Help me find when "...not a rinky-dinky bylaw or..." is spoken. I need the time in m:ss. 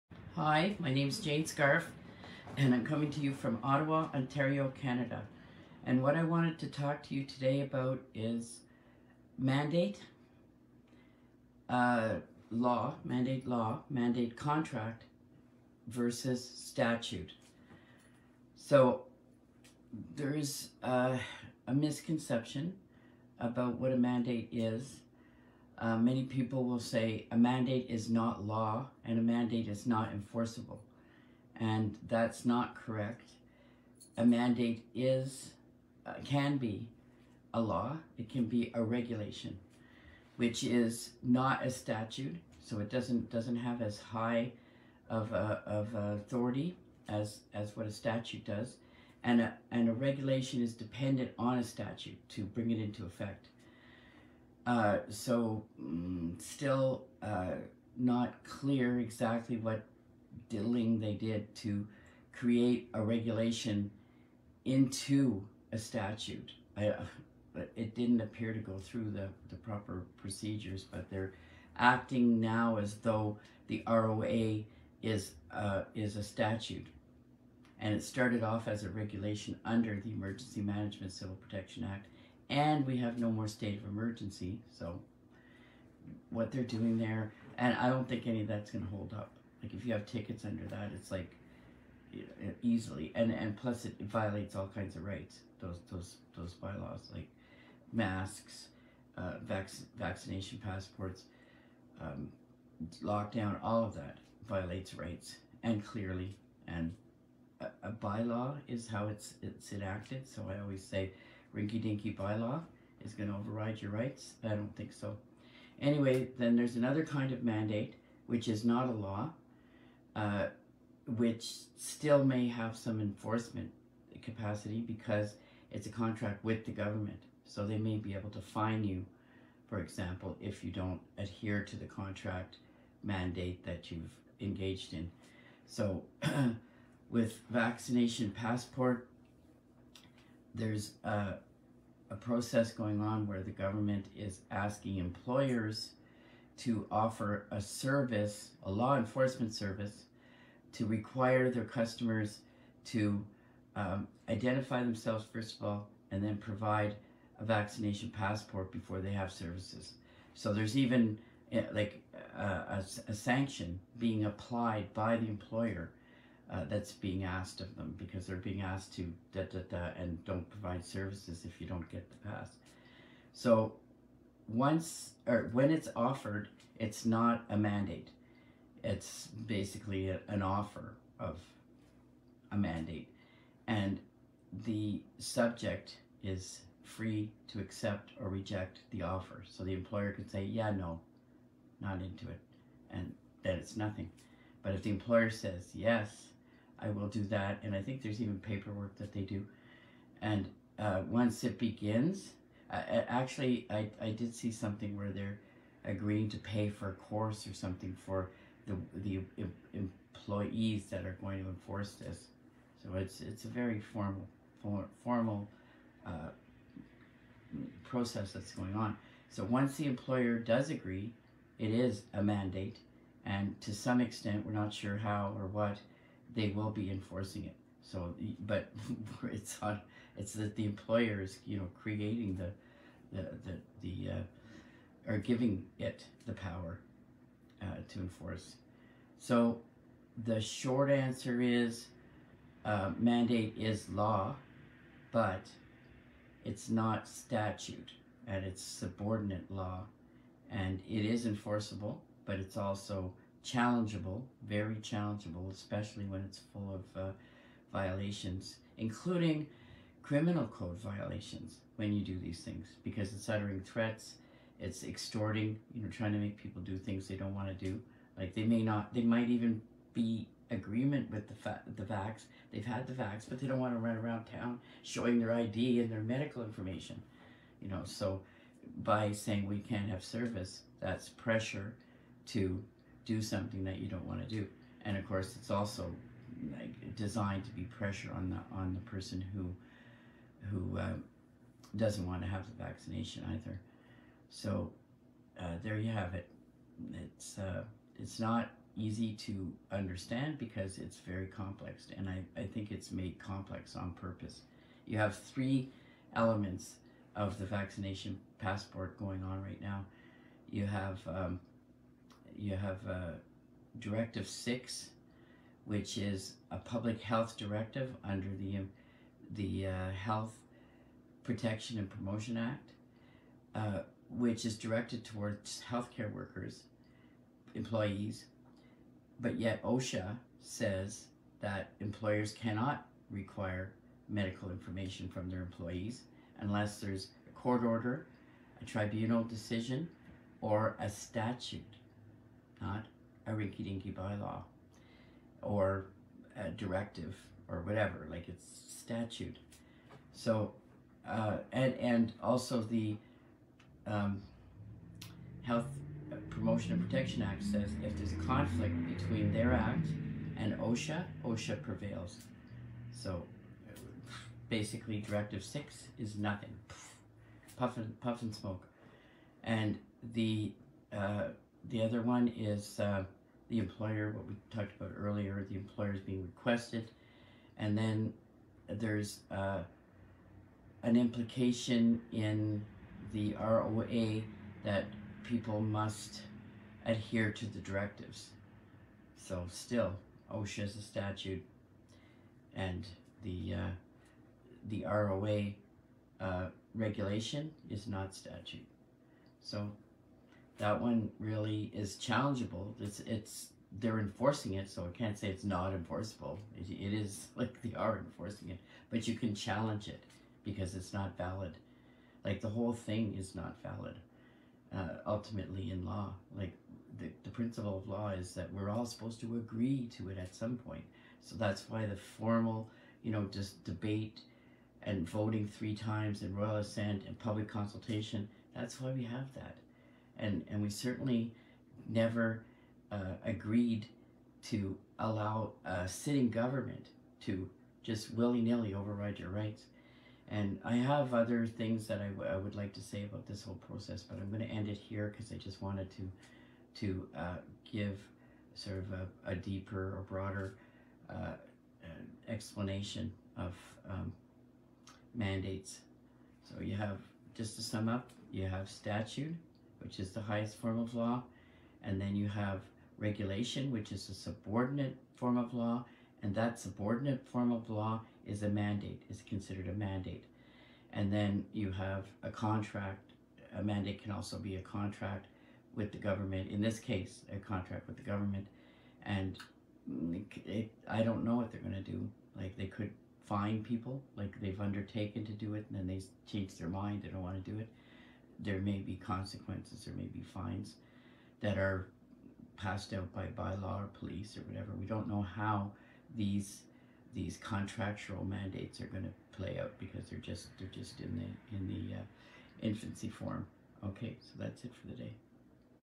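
5:42.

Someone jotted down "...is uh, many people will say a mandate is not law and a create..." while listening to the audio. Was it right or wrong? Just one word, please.
wrong.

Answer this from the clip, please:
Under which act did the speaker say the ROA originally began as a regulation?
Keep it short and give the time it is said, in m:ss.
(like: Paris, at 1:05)
Emergency Management Civil Protection Act, at 1:20.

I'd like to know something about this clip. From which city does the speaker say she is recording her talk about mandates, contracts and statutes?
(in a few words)
Ottawa.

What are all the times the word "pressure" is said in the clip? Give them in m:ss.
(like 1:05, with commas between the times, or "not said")
4:41, 4:47.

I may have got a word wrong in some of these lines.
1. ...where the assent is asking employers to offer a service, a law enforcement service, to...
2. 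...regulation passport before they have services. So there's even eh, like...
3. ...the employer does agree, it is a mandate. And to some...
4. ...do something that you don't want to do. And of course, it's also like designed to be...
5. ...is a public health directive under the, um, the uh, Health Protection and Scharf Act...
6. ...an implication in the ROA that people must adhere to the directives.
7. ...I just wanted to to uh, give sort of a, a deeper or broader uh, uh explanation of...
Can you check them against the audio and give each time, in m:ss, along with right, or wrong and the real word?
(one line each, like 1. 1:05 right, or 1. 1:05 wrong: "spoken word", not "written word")
1. 2:23 wrong: "government", not "assent"
2. 2:37 wrong: "vaccination", not "regulation"
3. 3:39 right
4. 4:43 right
5. 5:15 wrong: "Promotion", not "Scharf"
6. 6:20 right
7. 7:25 right.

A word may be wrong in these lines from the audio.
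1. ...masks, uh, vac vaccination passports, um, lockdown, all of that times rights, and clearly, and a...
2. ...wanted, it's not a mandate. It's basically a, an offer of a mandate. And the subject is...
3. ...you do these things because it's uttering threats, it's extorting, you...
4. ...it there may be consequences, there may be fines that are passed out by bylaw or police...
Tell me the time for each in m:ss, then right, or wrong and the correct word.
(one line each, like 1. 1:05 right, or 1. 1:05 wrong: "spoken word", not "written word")
1. 1:37 wrong: "violates", not "times"
2. 2:55 wrong: "offered", not "wanted"
3. 4:21 right
4. 8:07 right.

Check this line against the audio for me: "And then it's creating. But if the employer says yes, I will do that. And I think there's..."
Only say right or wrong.
wrong.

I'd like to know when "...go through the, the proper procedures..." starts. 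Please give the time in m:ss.
1:08.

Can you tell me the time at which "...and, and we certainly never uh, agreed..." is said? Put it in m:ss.
7:10.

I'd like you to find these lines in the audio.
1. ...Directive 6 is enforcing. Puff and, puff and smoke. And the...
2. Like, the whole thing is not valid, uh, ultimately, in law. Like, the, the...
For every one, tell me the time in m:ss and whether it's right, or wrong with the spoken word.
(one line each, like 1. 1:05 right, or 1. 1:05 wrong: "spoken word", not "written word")
1. 6:04 wrong: "nothing", not "enforcing"
2. 6:52 right.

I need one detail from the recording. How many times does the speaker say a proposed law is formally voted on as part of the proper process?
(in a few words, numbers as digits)
3.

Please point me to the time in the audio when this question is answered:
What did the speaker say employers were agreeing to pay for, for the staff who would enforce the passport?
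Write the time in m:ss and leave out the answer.
3:26.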